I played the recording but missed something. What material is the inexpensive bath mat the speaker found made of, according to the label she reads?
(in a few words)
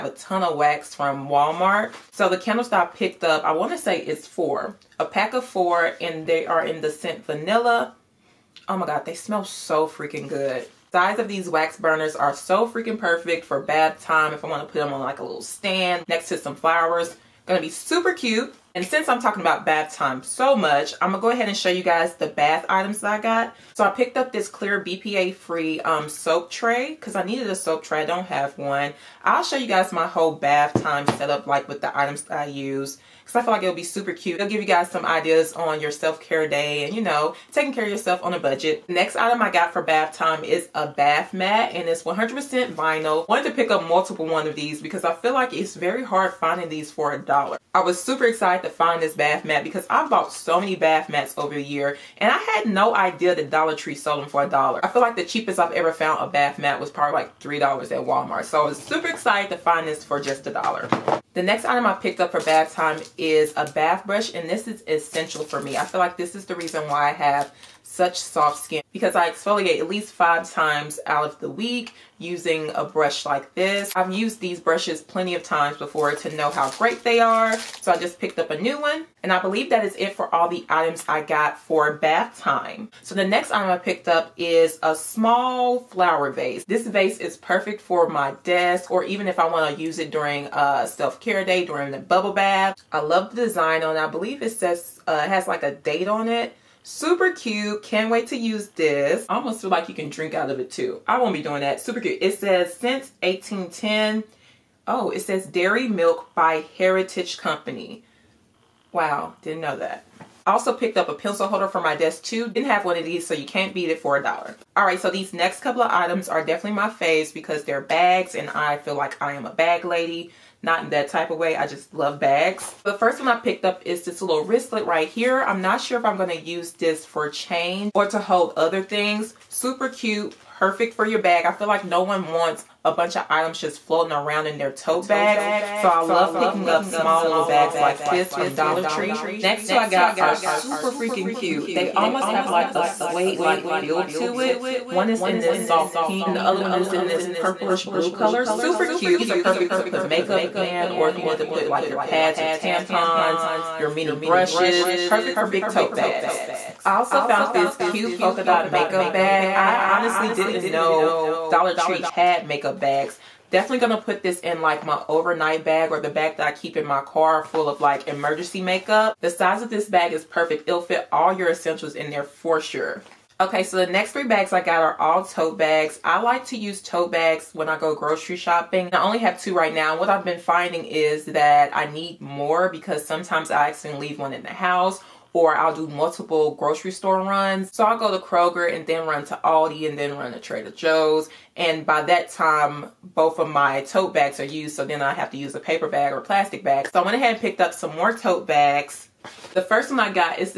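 100% vinyl.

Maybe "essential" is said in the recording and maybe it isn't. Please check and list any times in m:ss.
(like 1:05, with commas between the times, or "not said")
1:04, 2:51.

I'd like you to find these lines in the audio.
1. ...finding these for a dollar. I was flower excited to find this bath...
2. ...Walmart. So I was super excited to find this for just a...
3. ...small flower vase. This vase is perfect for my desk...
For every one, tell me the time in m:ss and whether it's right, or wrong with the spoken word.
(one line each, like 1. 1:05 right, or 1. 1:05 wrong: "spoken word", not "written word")
1. 0:46 wrong: "super", not "flower"
2. 0:58 right
3. 1:24 right.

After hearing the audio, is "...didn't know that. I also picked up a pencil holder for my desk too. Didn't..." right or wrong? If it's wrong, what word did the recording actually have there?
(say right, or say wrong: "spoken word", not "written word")
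right.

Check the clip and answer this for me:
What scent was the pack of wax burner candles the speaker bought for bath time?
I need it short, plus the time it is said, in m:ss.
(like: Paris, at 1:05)
Vanilla, at 0:07.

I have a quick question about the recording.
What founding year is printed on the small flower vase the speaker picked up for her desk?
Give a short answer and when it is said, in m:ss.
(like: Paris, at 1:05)
1810, at 1:43.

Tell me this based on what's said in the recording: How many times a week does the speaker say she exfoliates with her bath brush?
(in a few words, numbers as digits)
5.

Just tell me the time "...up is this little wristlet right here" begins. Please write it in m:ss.
2:03.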